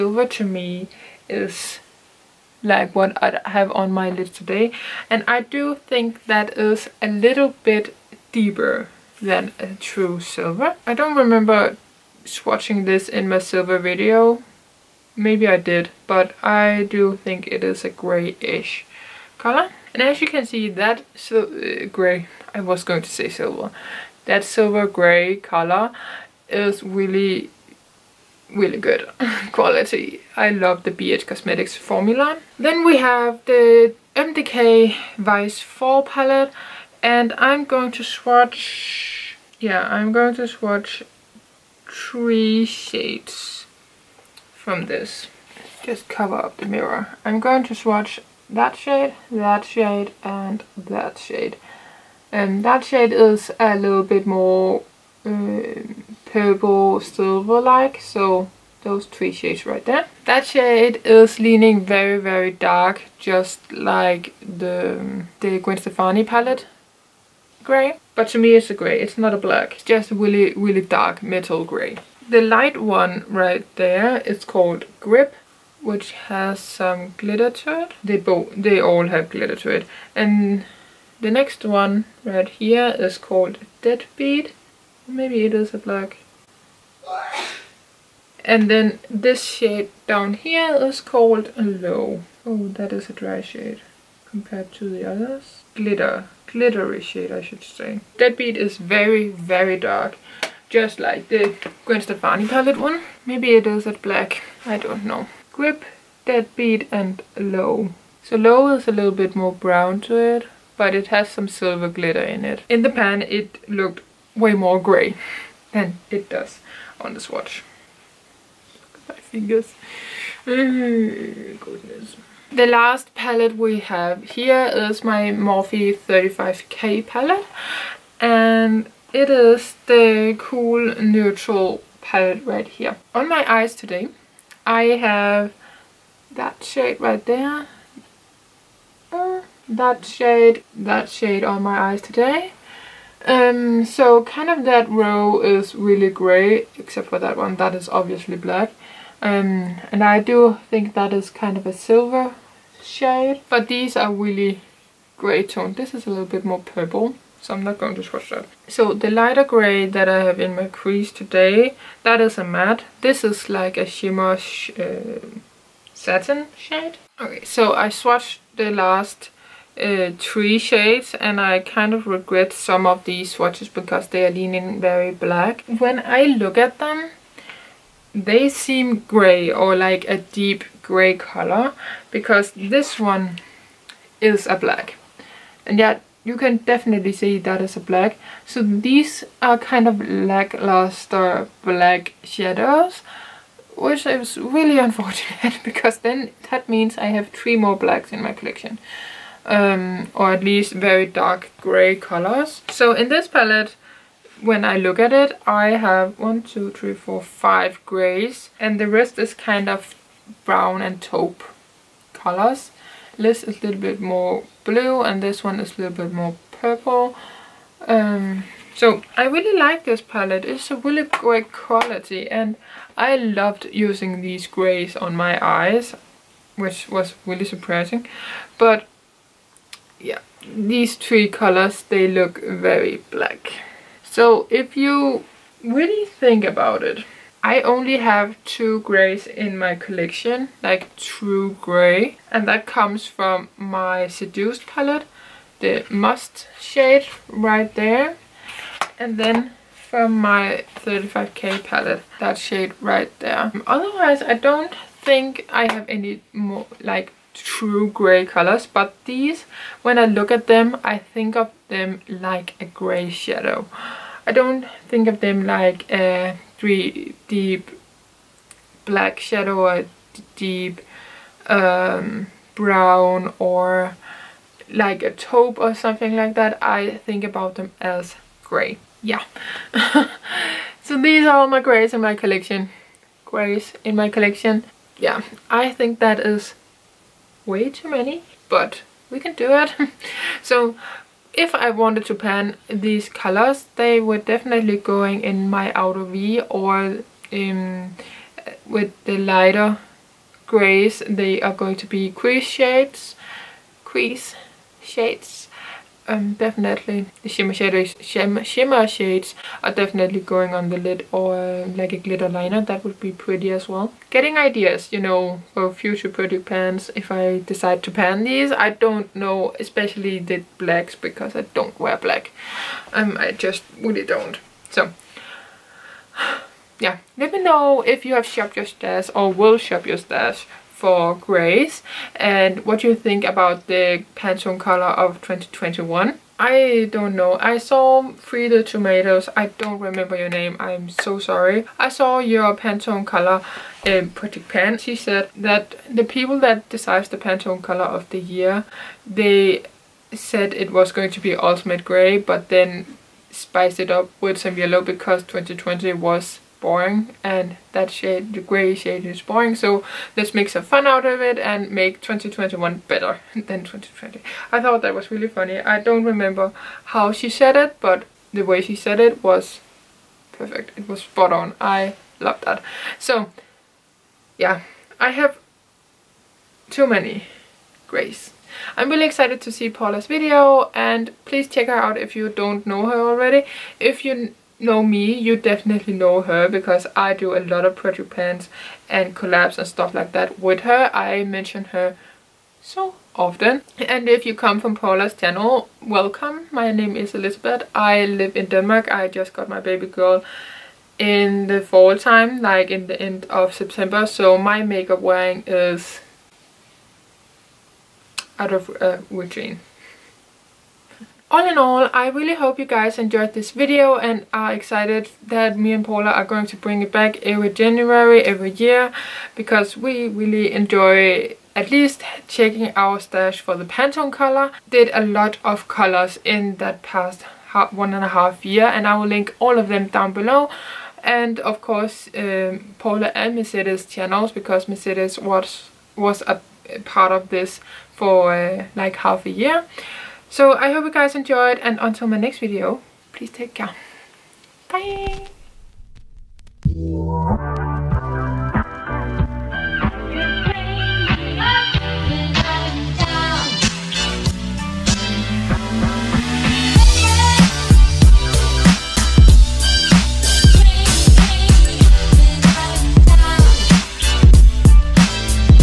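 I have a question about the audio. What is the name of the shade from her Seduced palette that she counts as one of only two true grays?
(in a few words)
Must.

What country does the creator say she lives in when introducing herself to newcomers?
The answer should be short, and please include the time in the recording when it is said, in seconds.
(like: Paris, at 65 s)
Denmark, at 398 s.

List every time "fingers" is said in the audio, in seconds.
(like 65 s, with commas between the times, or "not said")
119 s.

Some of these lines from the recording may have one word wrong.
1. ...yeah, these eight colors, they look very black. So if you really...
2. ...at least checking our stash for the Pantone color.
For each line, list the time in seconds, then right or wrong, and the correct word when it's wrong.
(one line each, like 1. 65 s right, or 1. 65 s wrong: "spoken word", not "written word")
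1. 230 s wrong: "three", not "eight"
2. 421 s right.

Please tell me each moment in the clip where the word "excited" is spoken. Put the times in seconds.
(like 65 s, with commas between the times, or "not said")
379 s, 414 s.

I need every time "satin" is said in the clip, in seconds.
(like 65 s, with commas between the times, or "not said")
165 s.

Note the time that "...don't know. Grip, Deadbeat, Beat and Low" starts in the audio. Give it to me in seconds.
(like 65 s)
104 s.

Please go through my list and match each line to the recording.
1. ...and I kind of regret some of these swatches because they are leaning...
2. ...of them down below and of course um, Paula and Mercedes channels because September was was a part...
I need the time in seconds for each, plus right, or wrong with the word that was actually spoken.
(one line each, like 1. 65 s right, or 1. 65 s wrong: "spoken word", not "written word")
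1. 171 s right
2. 429 s wrong: "Mercedes", not "September".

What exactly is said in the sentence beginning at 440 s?
So I hope you guys enjoyed and until my next video, please take care.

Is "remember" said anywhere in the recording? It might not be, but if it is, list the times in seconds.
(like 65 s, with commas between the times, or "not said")
11 s, 339 s, 366 s.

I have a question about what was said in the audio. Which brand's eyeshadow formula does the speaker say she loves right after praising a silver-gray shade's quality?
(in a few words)
BH Cosmetics.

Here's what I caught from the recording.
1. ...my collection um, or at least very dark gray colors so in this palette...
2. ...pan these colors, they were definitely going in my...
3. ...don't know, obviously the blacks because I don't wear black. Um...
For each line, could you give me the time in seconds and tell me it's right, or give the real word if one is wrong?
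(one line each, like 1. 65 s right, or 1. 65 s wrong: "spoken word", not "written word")
1. 198 s right
2. 292 s right
3. 318 s wrong: "especially", not "obviously".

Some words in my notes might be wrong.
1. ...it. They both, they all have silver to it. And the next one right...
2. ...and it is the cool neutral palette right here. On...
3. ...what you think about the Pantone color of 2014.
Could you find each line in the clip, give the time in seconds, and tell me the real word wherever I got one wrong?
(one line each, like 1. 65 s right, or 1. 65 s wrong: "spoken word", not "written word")
1. 77 s wrong: "glitter", not "silver"
2. 128 s right
3. 332 s wrong: "2021", not "2014".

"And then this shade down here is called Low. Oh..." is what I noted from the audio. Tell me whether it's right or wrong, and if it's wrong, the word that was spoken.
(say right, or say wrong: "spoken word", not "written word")
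right.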